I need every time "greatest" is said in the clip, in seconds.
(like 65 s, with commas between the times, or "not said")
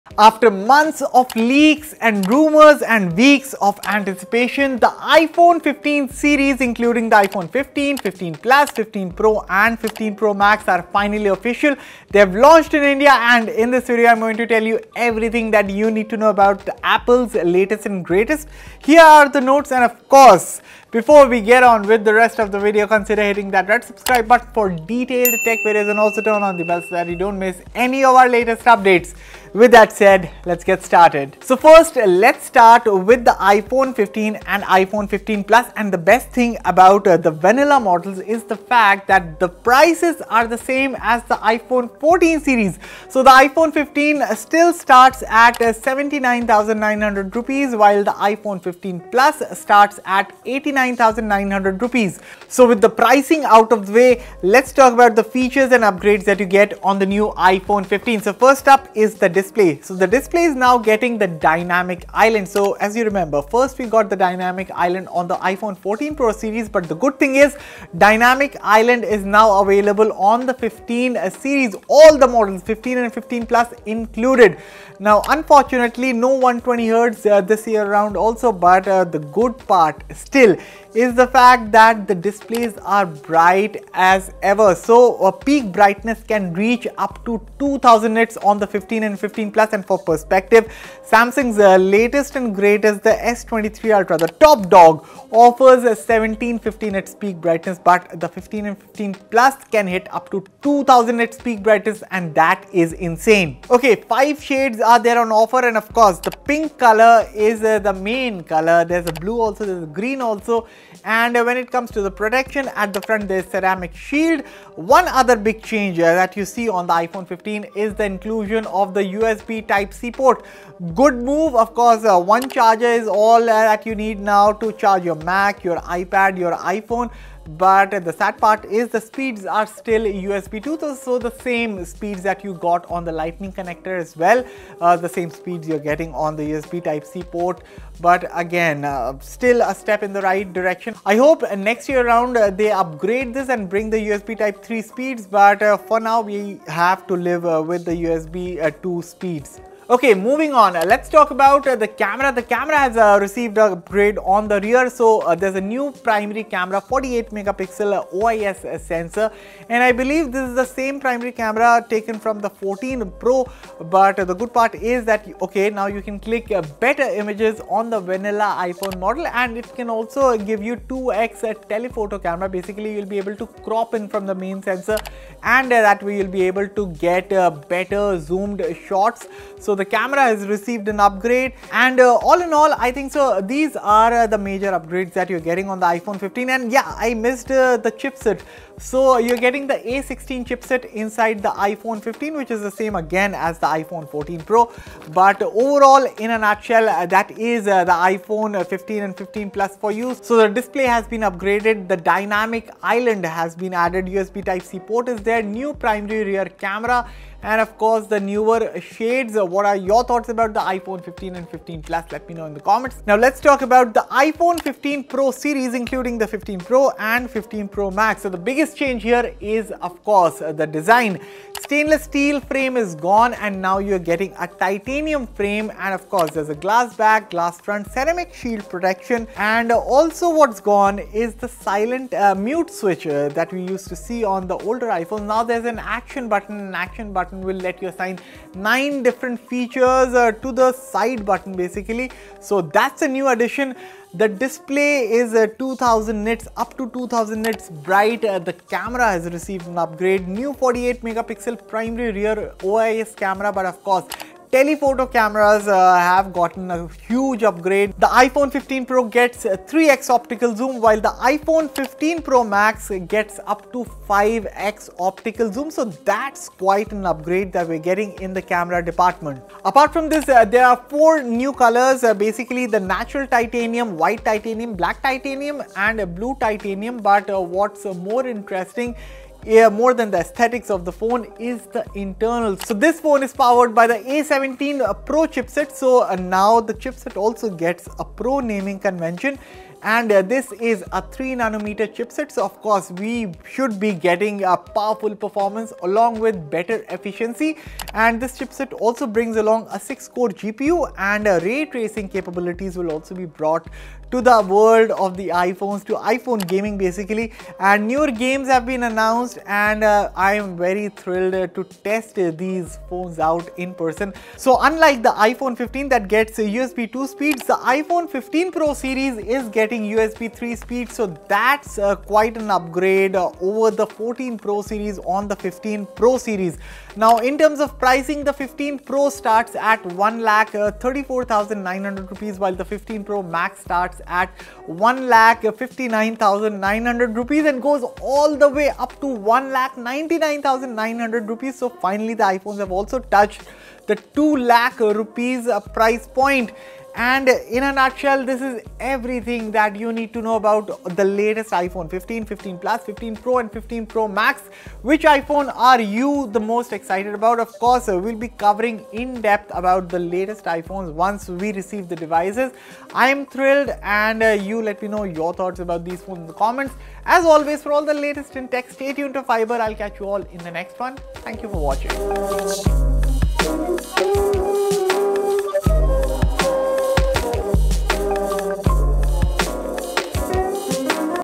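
18 s, 92 s.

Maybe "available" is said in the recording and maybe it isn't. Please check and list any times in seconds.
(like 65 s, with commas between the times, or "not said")
69 s.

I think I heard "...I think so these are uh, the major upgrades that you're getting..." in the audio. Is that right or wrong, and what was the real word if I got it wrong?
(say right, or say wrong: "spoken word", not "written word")
right.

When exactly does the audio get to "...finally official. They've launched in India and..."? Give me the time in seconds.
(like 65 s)
10 s.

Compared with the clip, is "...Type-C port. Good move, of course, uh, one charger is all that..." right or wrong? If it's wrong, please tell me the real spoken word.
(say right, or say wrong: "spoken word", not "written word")
right.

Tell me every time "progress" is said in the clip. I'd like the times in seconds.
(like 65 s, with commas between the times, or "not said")
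not said.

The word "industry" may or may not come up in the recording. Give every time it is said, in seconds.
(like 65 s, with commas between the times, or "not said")
not said.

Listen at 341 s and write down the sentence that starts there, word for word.
So finally the iPhones have also touched the 2 lakh rupees price point.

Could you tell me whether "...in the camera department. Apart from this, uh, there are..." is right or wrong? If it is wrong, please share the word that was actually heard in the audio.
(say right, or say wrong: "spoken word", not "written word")
right.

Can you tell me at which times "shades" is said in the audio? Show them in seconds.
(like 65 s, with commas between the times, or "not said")
104 s, 208 s.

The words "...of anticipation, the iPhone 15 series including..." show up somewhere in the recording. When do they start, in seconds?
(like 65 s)
3 s.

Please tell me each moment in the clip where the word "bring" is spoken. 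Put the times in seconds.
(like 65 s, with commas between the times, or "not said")
143 s, 299 s.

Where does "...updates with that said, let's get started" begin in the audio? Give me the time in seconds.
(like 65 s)
28 s.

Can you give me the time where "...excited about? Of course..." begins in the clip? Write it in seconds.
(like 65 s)
356 s.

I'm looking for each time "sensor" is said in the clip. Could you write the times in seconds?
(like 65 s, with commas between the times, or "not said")
158 s, 174 s.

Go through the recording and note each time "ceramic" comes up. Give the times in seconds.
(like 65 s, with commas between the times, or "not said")
113 s, 227 s.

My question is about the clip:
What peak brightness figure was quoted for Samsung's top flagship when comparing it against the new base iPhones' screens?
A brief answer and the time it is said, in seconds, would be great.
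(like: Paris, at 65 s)
1715 nits, at 95 s.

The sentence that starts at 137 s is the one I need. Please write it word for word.
But again, uh, still a step in the right direction.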